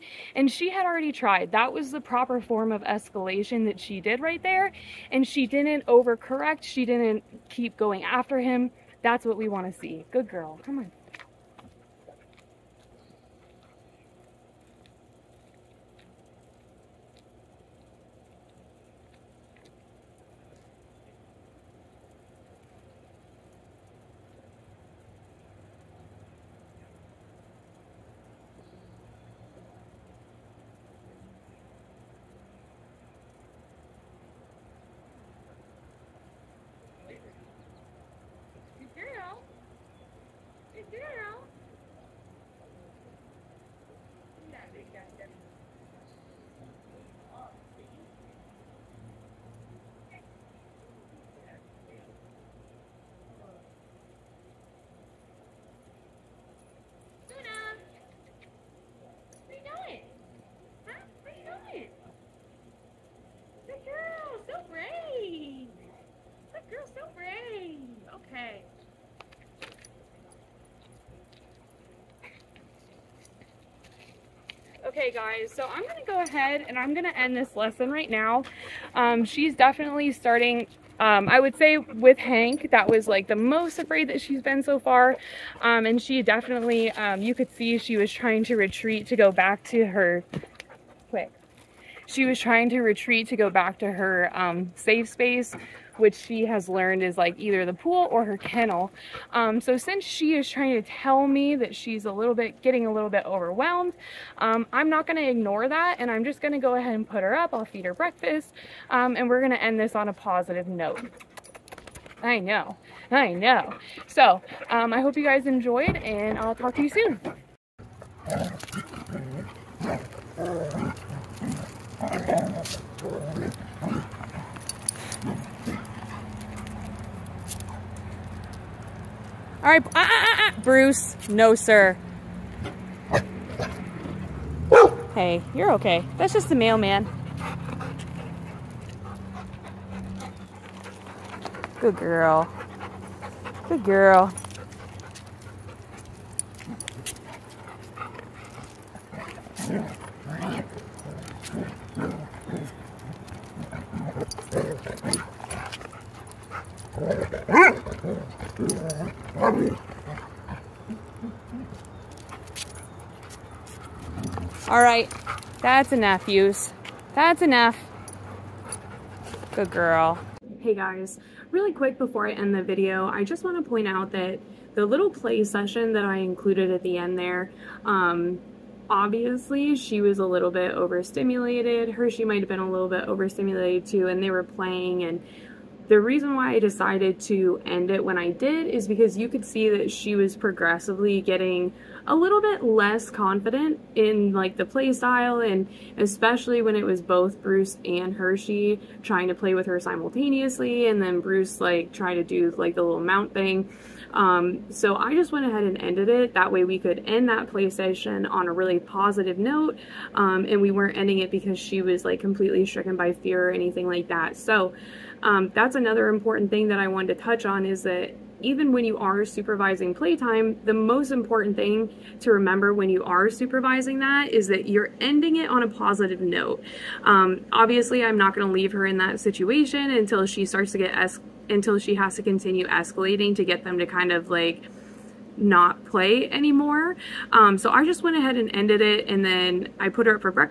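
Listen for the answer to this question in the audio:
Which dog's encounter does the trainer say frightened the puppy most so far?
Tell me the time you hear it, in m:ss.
1:22.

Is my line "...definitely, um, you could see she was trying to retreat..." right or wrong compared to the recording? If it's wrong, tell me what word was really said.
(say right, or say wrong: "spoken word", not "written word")
right.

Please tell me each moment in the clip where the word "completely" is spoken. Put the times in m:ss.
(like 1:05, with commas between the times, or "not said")
3:32.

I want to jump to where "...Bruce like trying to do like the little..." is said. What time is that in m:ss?
3:21.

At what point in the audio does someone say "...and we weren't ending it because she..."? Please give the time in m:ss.
3:30.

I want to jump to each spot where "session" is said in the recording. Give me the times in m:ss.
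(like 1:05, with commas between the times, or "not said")
2:55, 3:27.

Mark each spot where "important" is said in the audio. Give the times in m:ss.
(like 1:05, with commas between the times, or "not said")
3:36, 3:41.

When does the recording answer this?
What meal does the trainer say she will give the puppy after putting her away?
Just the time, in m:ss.
1:47.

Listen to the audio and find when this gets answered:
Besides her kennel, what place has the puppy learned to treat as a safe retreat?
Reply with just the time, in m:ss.
1:37.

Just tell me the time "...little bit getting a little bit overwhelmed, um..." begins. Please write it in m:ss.
1:42.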